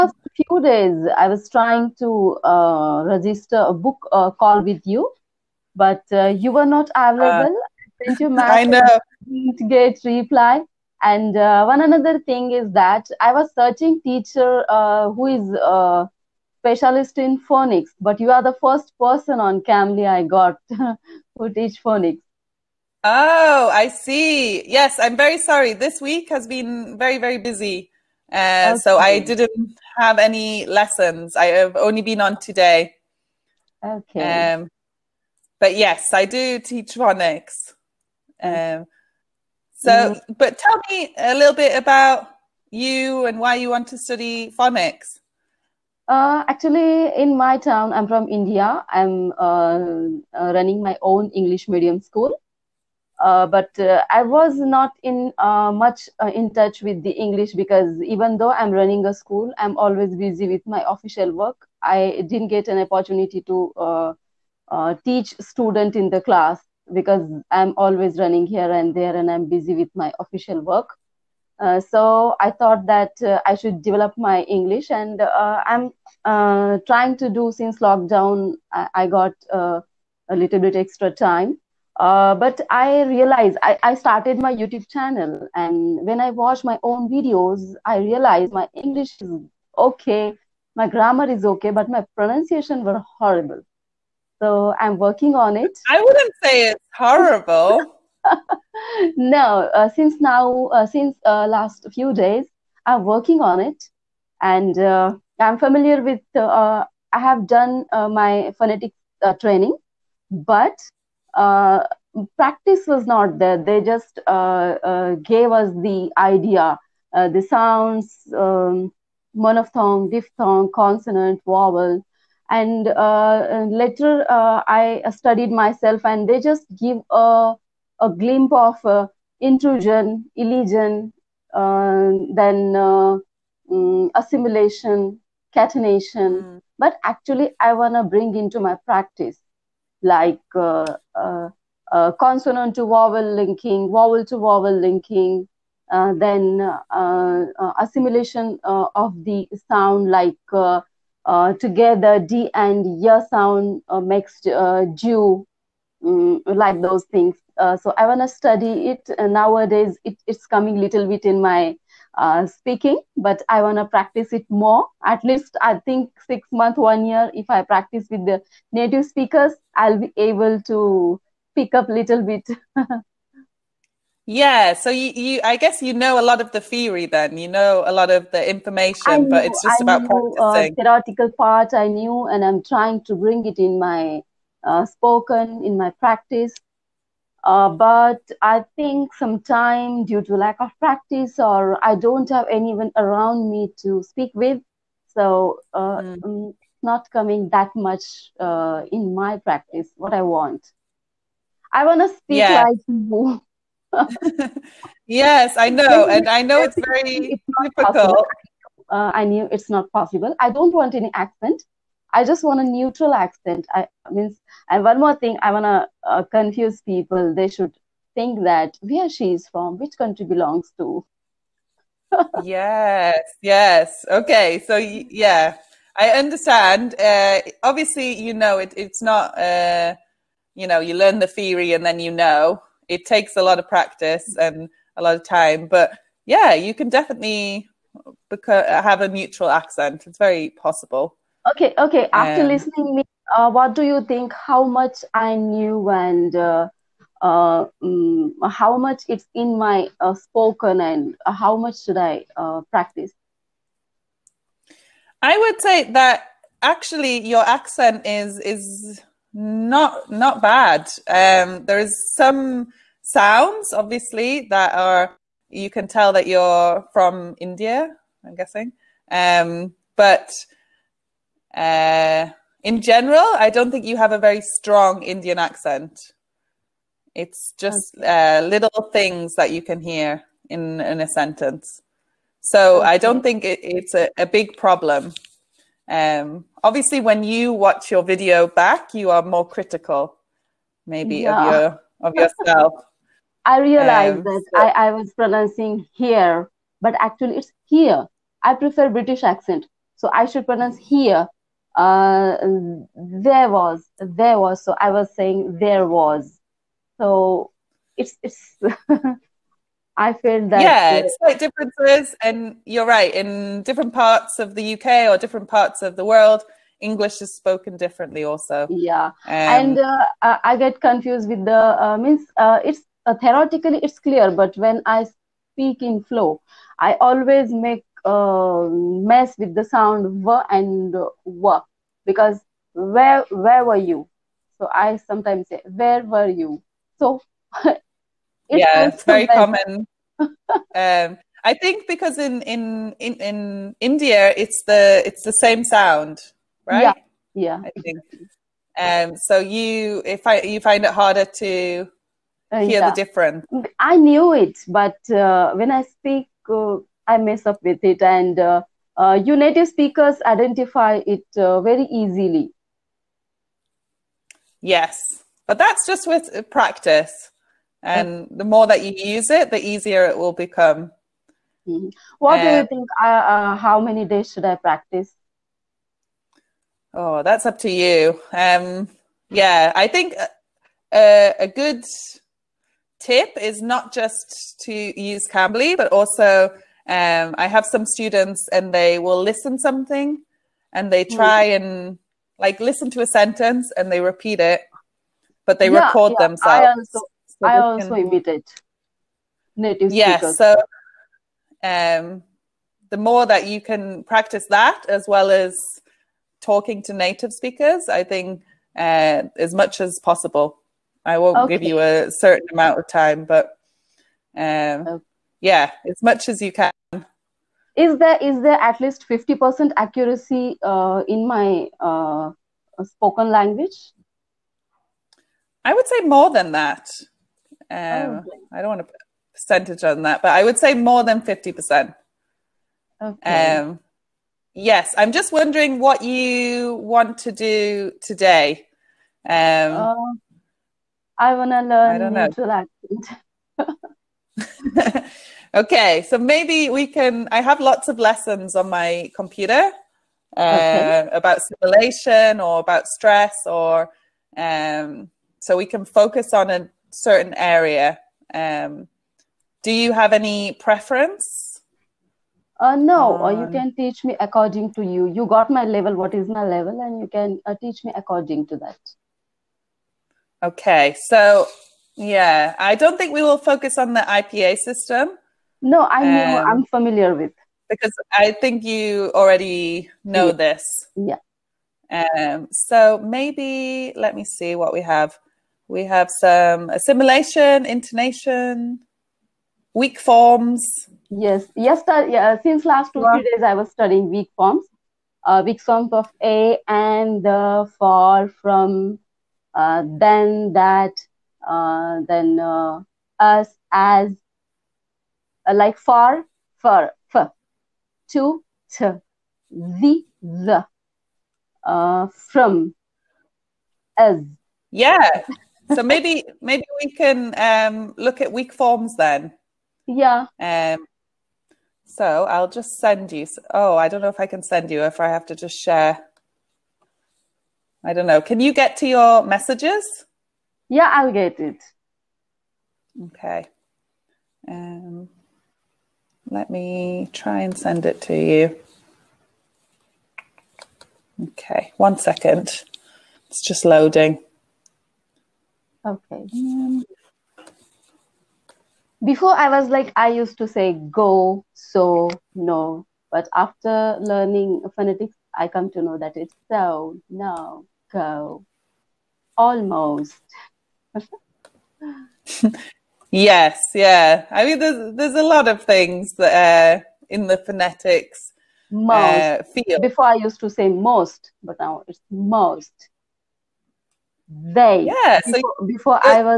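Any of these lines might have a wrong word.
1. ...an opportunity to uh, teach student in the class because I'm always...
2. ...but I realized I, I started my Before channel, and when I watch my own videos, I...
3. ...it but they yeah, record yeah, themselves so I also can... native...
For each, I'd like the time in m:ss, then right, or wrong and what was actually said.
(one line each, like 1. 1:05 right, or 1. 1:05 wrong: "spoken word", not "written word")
1. 1:02 right
2. 1:22 wrong: "YouTube", not "Before"
3. 6:34 right.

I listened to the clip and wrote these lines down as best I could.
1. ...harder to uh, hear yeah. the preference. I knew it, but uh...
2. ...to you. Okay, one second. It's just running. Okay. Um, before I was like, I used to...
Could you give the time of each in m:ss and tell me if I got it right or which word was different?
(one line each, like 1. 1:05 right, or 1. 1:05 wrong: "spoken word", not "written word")
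1. 5:50 wrong: "difference", not "preference"
2. 8:58 wrong: "loading", not "running".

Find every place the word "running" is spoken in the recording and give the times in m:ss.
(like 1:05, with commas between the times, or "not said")
0:50, 0:58, 1:08.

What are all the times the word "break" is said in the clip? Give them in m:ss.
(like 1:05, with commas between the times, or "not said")
not said.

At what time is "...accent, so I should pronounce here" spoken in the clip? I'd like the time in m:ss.
4:59.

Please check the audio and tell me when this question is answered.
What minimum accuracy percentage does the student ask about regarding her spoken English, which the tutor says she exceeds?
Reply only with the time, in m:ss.
6:59.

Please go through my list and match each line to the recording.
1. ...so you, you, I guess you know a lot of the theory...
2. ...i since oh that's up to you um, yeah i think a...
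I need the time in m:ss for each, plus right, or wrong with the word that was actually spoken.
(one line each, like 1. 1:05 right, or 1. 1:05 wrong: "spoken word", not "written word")
1. 2:54 right
2. 6:14 wrong: "practice", not "since".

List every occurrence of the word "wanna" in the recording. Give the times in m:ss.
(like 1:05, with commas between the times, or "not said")
2:17, 3:35.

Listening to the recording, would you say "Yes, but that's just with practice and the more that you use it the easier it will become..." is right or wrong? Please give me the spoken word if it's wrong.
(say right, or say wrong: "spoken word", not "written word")
right.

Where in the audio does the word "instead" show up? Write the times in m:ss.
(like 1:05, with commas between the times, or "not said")
not said.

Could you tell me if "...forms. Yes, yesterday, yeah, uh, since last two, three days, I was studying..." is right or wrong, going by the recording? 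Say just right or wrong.
right.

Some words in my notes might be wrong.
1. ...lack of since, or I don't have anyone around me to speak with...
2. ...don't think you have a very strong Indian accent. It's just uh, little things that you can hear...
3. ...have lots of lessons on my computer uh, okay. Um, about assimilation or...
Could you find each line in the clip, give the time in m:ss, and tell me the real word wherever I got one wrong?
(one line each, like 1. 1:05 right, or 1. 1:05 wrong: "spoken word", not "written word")
1. 3:10 wrong: "practice", not "since"
2. 4:33 right
3. 7:27 right.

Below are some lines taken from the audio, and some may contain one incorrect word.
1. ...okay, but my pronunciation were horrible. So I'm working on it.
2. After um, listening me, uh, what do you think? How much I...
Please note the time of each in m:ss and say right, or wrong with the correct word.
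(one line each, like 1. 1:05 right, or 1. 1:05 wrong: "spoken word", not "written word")
1. 1:31 right
2. 4:02 right.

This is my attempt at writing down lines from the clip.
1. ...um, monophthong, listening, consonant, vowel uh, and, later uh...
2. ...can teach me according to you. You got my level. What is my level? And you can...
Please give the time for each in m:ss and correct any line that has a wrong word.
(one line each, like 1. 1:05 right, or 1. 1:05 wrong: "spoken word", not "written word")
1. 1:58 wrong: "diphthong", not "listening"
2. 7:43 right.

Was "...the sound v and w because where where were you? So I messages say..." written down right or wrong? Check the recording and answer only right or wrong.
wrong.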